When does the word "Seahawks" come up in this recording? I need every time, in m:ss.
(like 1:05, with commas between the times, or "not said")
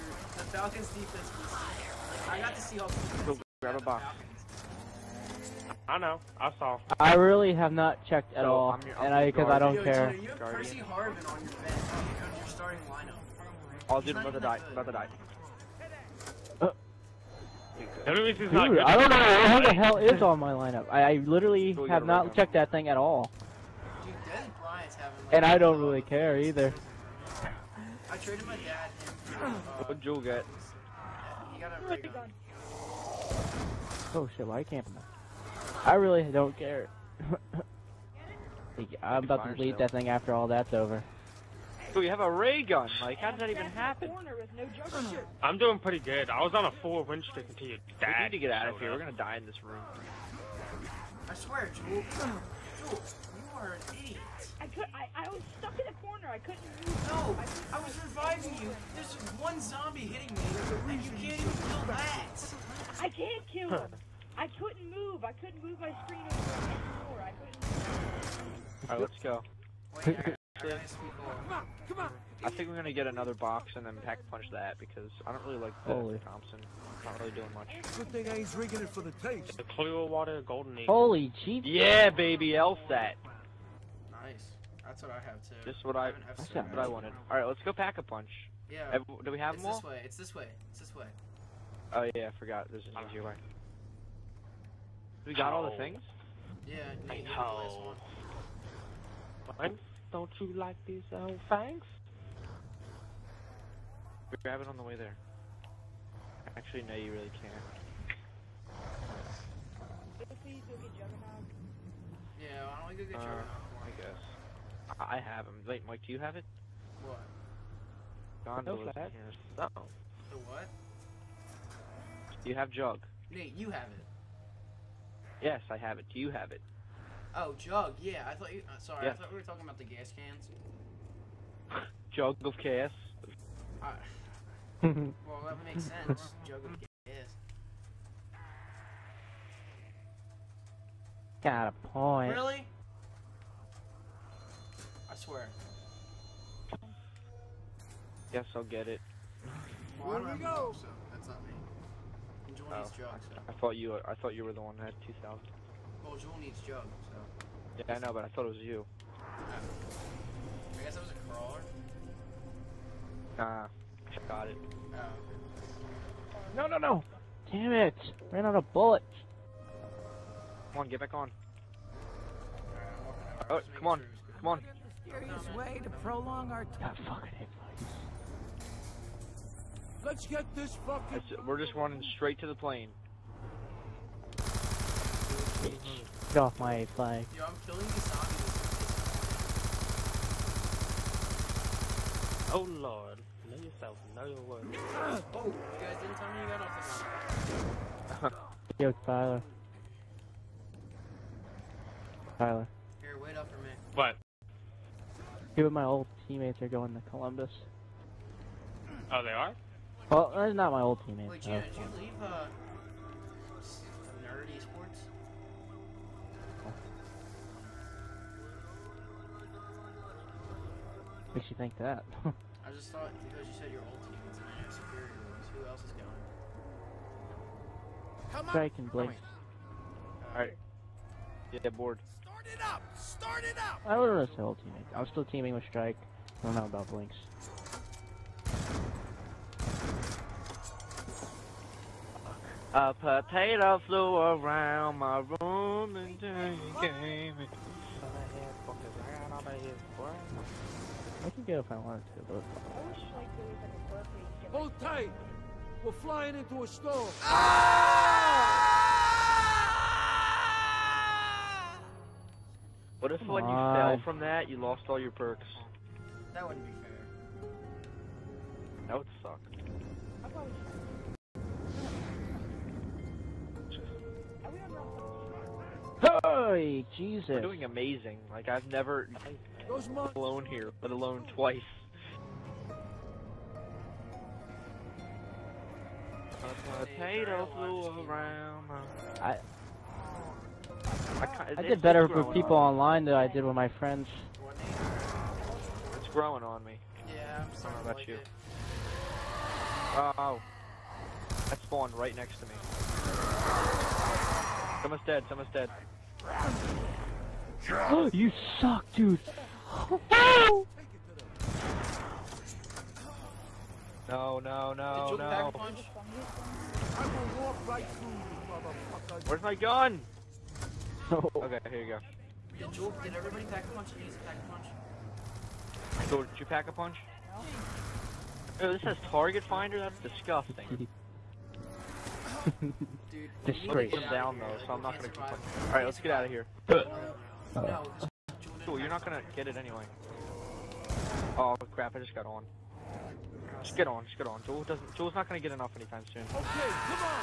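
0:02.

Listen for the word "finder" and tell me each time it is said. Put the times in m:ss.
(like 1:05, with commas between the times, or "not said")
5:29.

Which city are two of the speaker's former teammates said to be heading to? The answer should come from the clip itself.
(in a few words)
Columbus.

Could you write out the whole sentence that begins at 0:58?
There's one zombie hitting me, and you can't even kill that.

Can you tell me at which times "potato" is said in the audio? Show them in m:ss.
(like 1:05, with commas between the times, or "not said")
4:02, 4:46.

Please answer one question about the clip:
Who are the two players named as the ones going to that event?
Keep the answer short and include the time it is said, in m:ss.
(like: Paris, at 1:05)
Drake and Blake, at 3:48.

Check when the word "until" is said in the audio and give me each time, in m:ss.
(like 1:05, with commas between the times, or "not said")
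0:47, 4:05.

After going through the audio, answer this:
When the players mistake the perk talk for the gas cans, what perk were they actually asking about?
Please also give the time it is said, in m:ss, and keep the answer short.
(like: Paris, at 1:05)
Juggernaut, at 1:53.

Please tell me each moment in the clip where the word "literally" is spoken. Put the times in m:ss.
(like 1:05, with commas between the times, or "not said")
0:21.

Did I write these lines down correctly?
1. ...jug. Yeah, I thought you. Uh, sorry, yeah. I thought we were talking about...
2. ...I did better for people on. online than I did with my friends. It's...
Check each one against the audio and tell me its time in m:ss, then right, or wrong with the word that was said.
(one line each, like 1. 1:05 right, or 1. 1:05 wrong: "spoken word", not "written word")
1. 2:07 right
2. 4:51 right.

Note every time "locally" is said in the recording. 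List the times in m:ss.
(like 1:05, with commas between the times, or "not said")
not said.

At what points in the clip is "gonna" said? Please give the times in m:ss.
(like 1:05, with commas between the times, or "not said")
0:48, 1:12, 5:34, 5:39, 5:45.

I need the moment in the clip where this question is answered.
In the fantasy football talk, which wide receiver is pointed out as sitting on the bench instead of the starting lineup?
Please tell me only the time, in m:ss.
0:10.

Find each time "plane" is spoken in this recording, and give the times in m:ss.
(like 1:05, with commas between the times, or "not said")
3:02, 3:18.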